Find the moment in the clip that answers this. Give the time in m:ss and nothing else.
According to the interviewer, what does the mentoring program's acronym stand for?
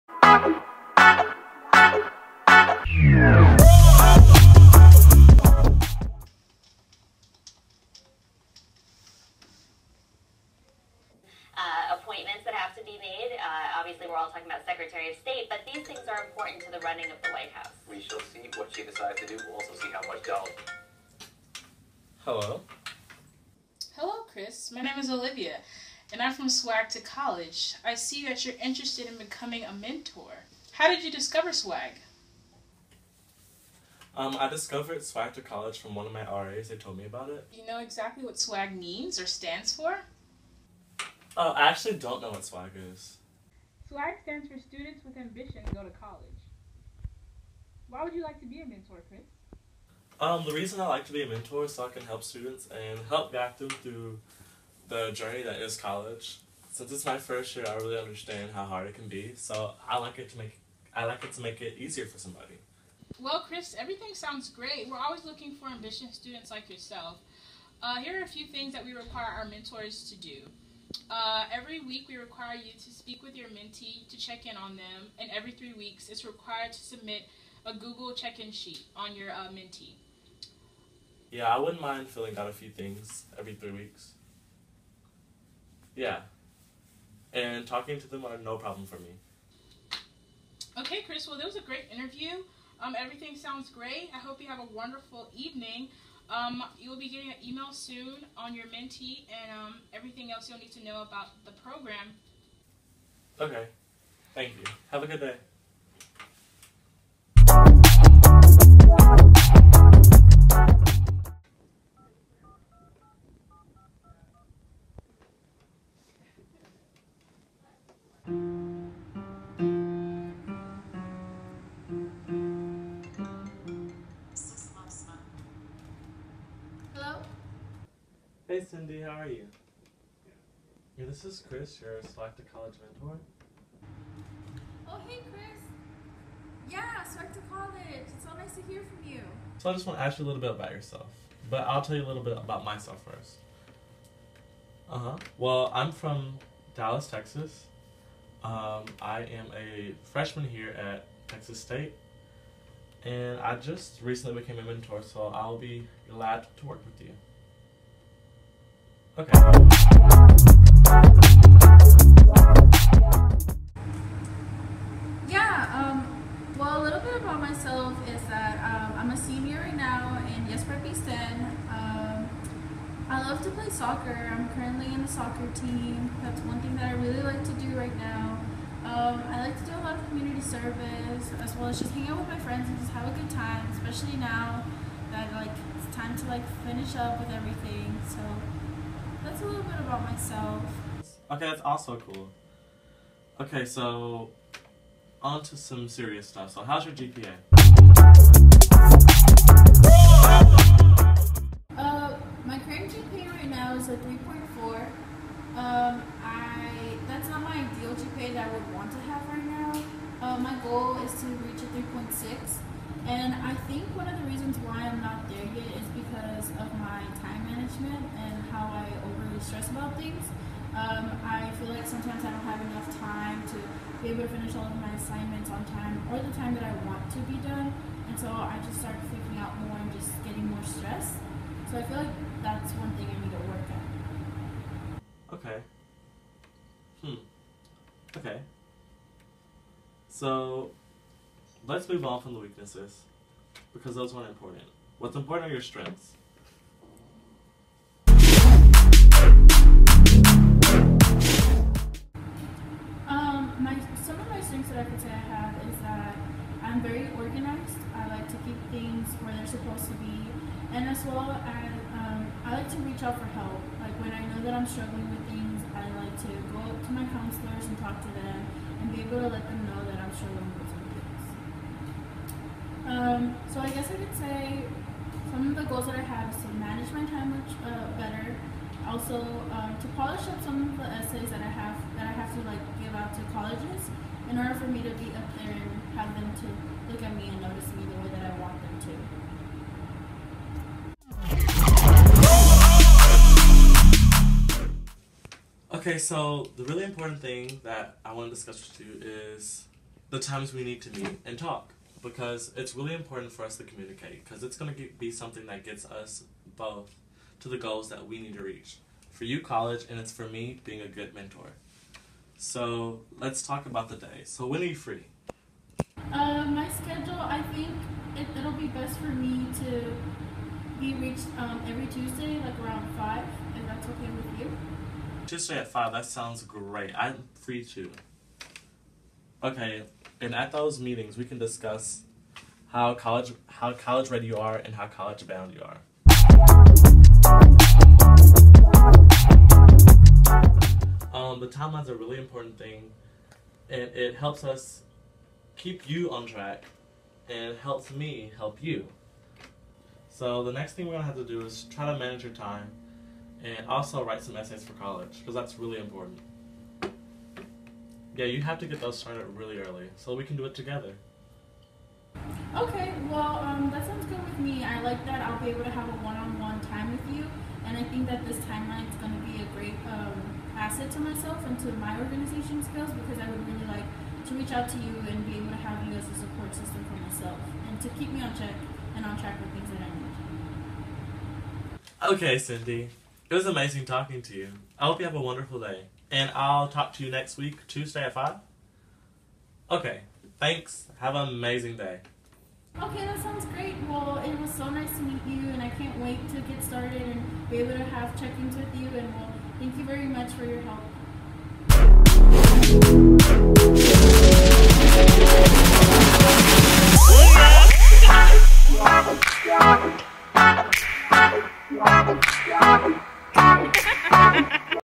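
0:44.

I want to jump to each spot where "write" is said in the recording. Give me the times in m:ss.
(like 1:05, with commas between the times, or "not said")
5:54.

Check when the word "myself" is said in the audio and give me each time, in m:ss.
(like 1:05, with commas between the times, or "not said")
2:22, 2:47, 3:10, 6:10, 6:16.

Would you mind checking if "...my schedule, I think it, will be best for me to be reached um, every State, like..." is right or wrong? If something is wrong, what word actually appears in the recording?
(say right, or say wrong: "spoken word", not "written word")
wrong: "Tuesday", not "State".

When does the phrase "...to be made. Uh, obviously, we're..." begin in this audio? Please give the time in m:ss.
0:12.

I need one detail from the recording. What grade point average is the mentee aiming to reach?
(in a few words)
3.6.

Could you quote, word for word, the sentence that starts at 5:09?
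For you, college, and it's for me, being a good mentor.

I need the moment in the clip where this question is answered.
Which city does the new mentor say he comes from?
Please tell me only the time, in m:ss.
2:26.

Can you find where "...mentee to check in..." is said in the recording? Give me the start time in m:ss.
1:13.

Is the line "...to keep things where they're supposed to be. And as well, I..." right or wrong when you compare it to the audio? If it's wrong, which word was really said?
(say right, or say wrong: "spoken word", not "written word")
right.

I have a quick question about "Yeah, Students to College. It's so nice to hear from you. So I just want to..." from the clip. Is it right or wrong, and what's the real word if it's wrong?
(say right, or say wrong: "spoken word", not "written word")
wrong: "Swag", not "Students".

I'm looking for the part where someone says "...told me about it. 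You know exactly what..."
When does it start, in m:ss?
0:36.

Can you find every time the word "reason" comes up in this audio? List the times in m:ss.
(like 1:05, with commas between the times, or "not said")
0:50, 3:34.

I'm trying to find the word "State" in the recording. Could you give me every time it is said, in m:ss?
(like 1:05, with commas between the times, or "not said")
0:15, 2:31.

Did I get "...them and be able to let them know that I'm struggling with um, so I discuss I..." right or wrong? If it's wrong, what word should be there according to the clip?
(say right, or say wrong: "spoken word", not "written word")
wrong: "guess", not "discuss".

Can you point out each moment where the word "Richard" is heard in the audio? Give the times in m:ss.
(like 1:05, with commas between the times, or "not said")
not said.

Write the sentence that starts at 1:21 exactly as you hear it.
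Yeah, I wouldn't mind filling out a few things every three weeks.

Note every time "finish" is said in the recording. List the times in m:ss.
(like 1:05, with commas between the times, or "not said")
3:06, 3:44.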